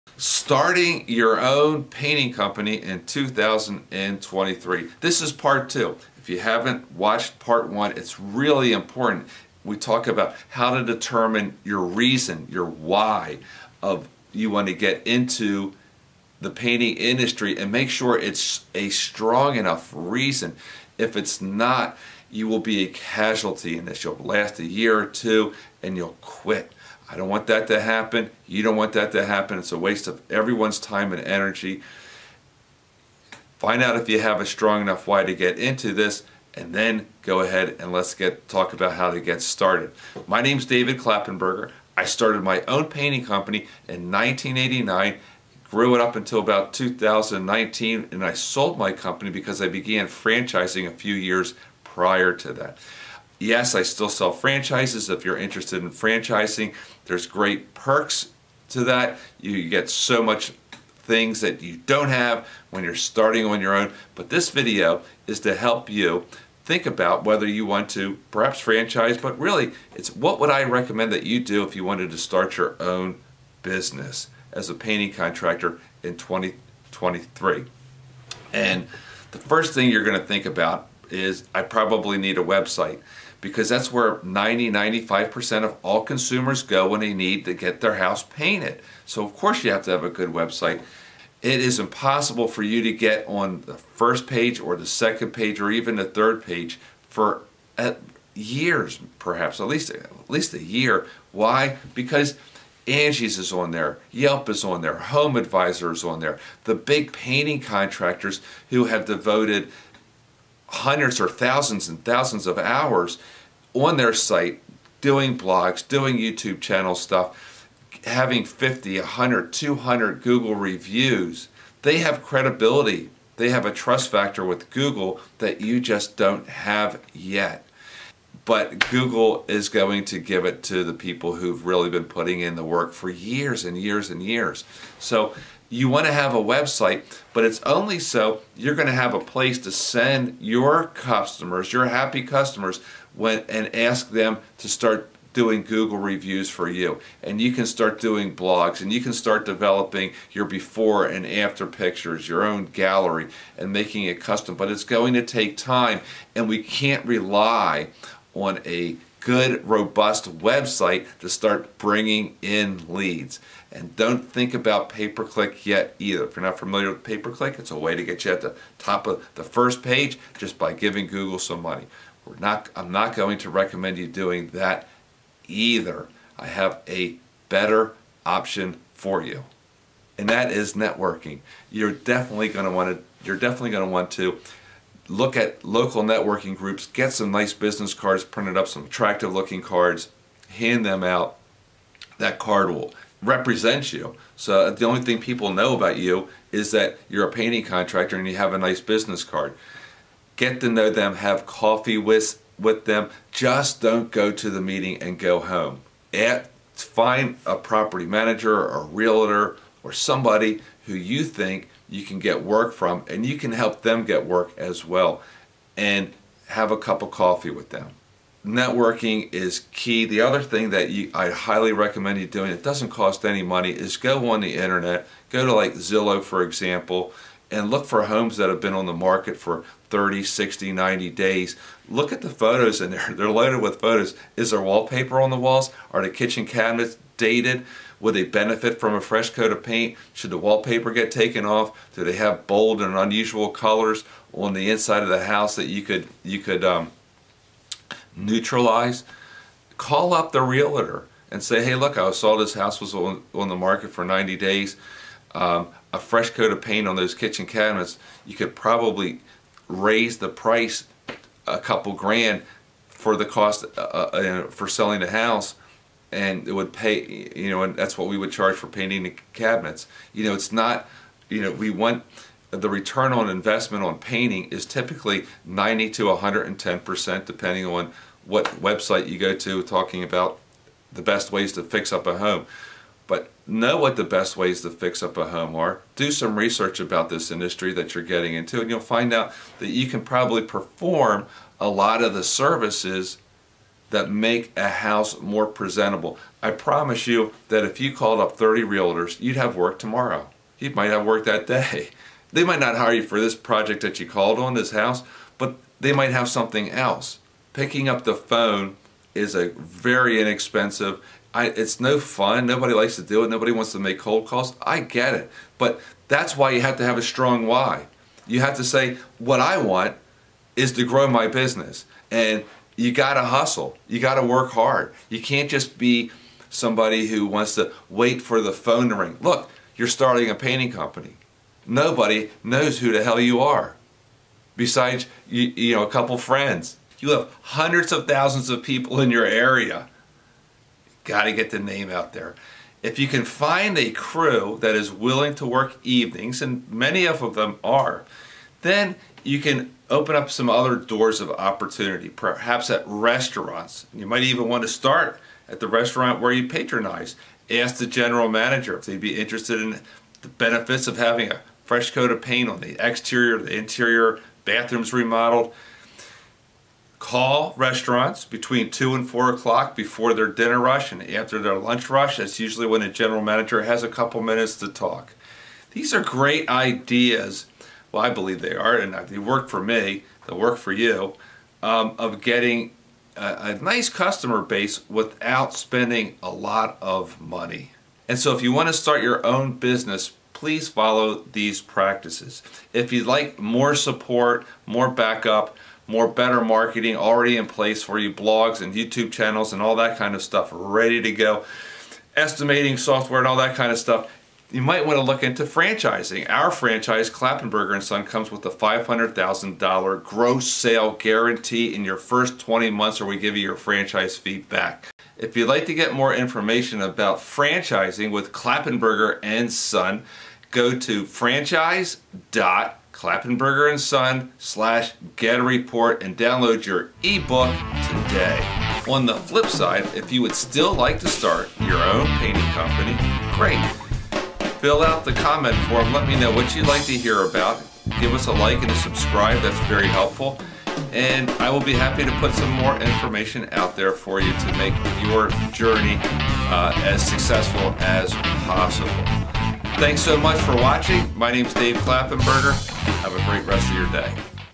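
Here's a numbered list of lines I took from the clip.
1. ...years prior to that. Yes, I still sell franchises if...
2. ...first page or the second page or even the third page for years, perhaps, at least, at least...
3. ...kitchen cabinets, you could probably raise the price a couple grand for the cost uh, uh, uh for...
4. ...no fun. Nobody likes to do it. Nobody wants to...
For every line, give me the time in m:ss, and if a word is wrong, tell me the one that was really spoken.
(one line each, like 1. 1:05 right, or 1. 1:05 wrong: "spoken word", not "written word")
1. 0:51 right
2. 1:33 right
3. 4:17 right
4. 5:11 right.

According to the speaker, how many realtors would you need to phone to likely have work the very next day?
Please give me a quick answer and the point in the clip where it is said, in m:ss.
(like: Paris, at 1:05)
30, at 4:58.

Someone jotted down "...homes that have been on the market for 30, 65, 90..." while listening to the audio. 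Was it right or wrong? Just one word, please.
wrong.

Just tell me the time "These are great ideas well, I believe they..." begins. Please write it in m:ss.
6:15.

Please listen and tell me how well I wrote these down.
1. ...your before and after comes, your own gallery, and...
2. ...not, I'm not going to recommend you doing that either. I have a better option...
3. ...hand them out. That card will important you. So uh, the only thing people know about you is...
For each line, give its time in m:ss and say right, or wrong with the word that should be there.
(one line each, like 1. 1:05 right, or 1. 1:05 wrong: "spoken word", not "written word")
1. 2:30 wrong: "pictures", not "comes"
2. 2:52 right
3. 3:10 wrong: "represent", not "important".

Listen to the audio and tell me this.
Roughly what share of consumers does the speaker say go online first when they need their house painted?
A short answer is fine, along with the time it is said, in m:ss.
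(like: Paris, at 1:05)
90-95%, at 1:24.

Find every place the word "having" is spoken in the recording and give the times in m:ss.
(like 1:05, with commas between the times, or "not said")
1:58, 6:00.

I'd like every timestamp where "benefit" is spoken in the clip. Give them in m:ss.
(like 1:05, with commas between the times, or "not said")
3:58, 6:00.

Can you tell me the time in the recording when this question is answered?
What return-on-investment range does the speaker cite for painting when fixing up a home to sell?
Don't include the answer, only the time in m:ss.
4:35.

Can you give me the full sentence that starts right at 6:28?
And so if you want to start your own business, please follow these practices.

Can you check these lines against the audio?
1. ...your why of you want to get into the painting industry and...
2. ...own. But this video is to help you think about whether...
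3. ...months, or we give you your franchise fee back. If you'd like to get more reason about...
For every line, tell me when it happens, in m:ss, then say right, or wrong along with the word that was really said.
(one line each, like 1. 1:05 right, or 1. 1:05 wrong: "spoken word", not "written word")
1. 0:12 right
2. 1:03 right
3. 6:52 wrong: "information", not "reason".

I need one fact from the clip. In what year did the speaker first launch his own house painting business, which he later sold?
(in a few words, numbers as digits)
1989.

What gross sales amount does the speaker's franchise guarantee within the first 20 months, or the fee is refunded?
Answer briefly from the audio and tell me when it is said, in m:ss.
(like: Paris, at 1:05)
$500,000, at 6:48.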